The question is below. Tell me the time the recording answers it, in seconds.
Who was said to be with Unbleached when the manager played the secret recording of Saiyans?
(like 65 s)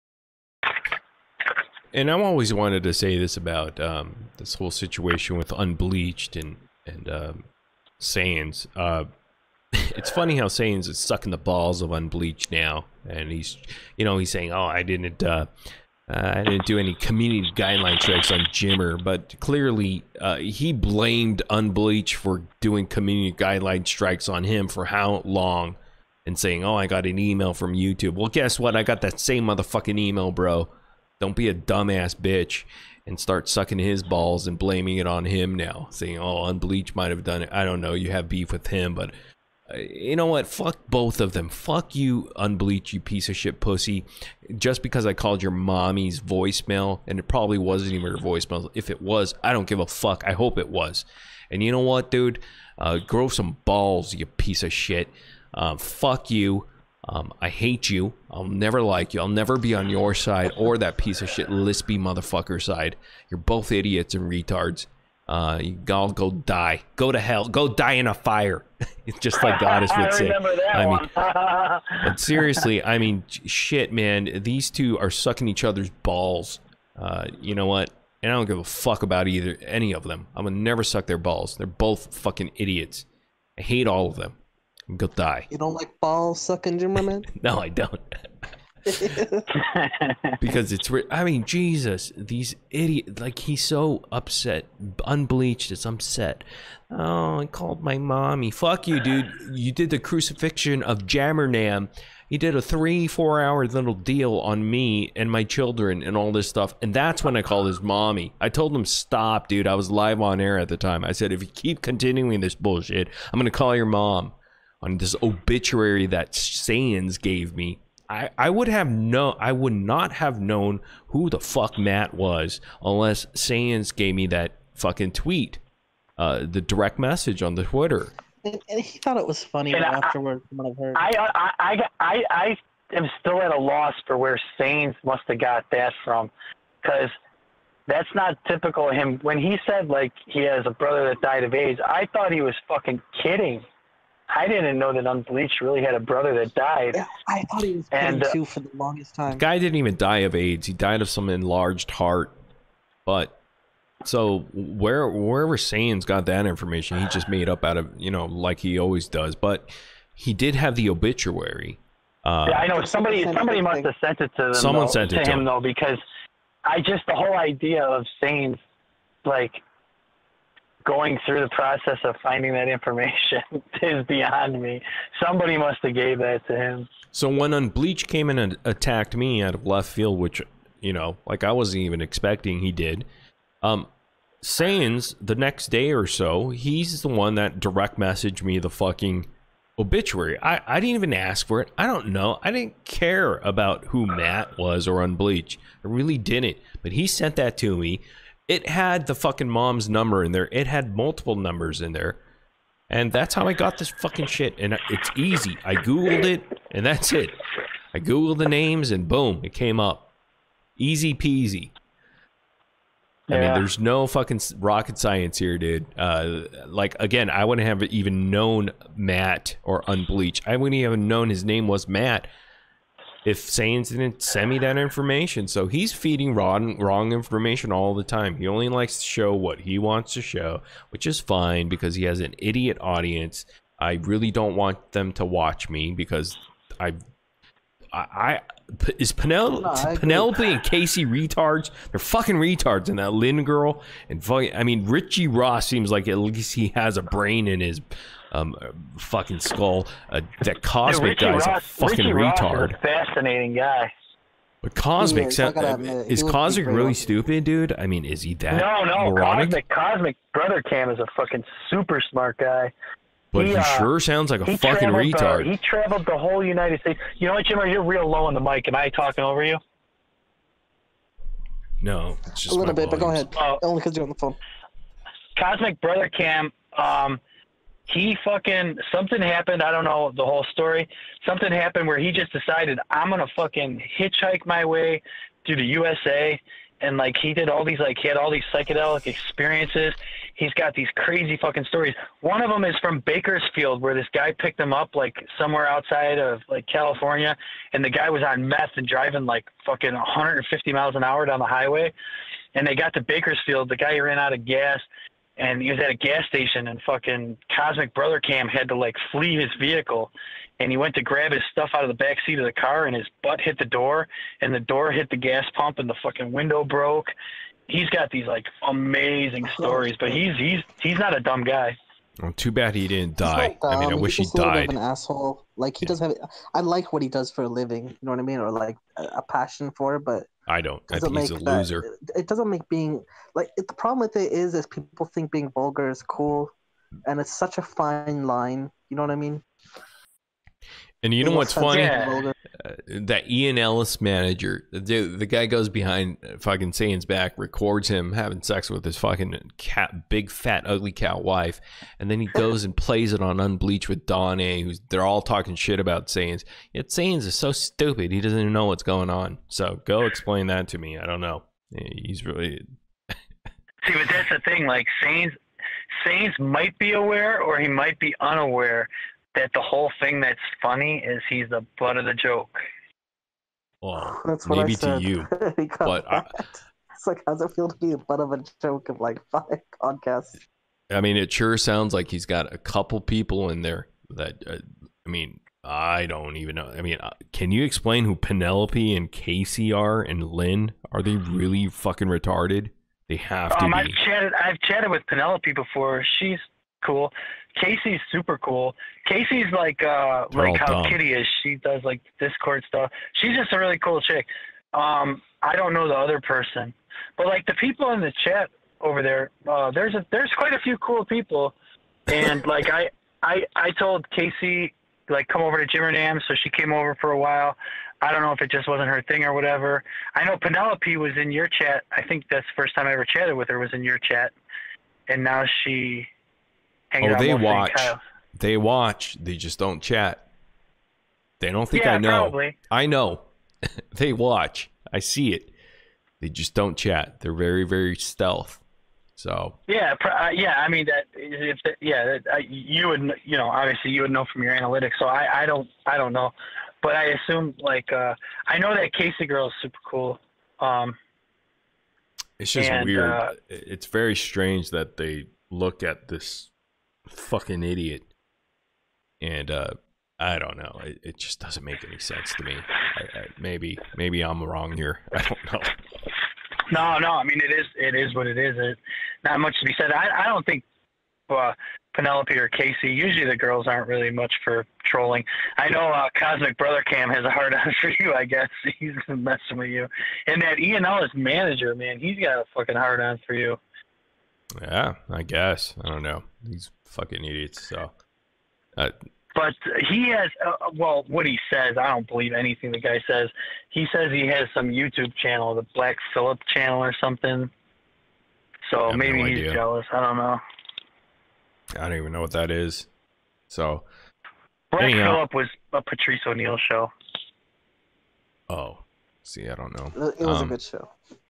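354 s.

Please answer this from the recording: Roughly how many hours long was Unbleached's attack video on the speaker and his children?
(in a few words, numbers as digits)
3-4 hours.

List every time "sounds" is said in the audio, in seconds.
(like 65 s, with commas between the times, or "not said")
263 s, 381 s.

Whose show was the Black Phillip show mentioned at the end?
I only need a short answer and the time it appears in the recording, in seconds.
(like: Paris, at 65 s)
Patrice O'Neal, at 505 s.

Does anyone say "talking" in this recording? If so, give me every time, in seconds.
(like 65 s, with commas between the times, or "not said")
268 s, 355 s.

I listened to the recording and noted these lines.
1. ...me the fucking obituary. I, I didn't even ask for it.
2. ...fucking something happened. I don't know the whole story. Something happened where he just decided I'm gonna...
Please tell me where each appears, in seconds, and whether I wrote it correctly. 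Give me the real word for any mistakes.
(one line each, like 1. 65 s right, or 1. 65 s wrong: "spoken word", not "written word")
1. 188 s right
2. 278 s right.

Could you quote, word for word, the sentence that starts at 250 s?
Uh, that Cosmic Dude, guy's Ross, a fucking Richie retard.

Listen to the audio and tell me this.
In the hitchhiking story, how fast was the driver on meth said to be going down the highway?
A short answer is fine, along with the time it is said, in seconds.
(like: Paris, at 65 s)
150 miles an hour, at 299 s.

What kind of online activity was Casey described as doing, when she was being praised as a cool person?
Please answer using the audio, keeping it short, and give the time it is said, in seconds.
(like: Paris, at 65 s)
Discord stuff, at 402 s.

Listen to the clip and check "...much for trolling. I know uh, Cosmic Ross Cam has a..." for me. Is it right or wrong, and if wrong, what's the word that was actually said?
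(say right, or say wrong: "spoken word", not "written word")
wrong: "Brother", not "Ross".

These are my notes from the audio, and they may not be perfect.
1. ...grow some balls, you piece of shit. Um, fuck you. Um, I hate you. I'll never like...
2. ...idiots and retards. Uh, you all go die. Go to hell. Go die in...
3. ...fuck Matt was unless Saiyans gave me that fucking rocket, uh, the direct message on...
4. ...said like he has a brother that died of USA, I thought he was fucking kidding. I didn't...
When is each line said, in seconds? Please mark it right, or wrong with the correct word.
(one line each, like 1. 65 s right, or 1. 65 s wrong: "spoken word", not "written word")
1. 52 s right
2. 63 s right
3. 121 s wrong: "tweet", not "rocket"
4. 139 s wrong: "AIDS", not "USA".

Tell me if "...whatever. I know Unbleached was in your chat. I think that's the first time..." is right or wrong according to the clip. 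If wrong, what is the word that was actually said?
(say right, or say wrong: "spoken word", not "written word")
wrong: "Penelope", not "Unbleached".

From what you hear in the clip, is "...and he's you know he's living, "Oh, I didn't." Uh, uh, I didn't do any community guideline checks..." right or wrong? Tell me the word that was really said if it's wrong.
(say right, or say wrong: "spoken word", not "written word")
wrong: "saying", not "living".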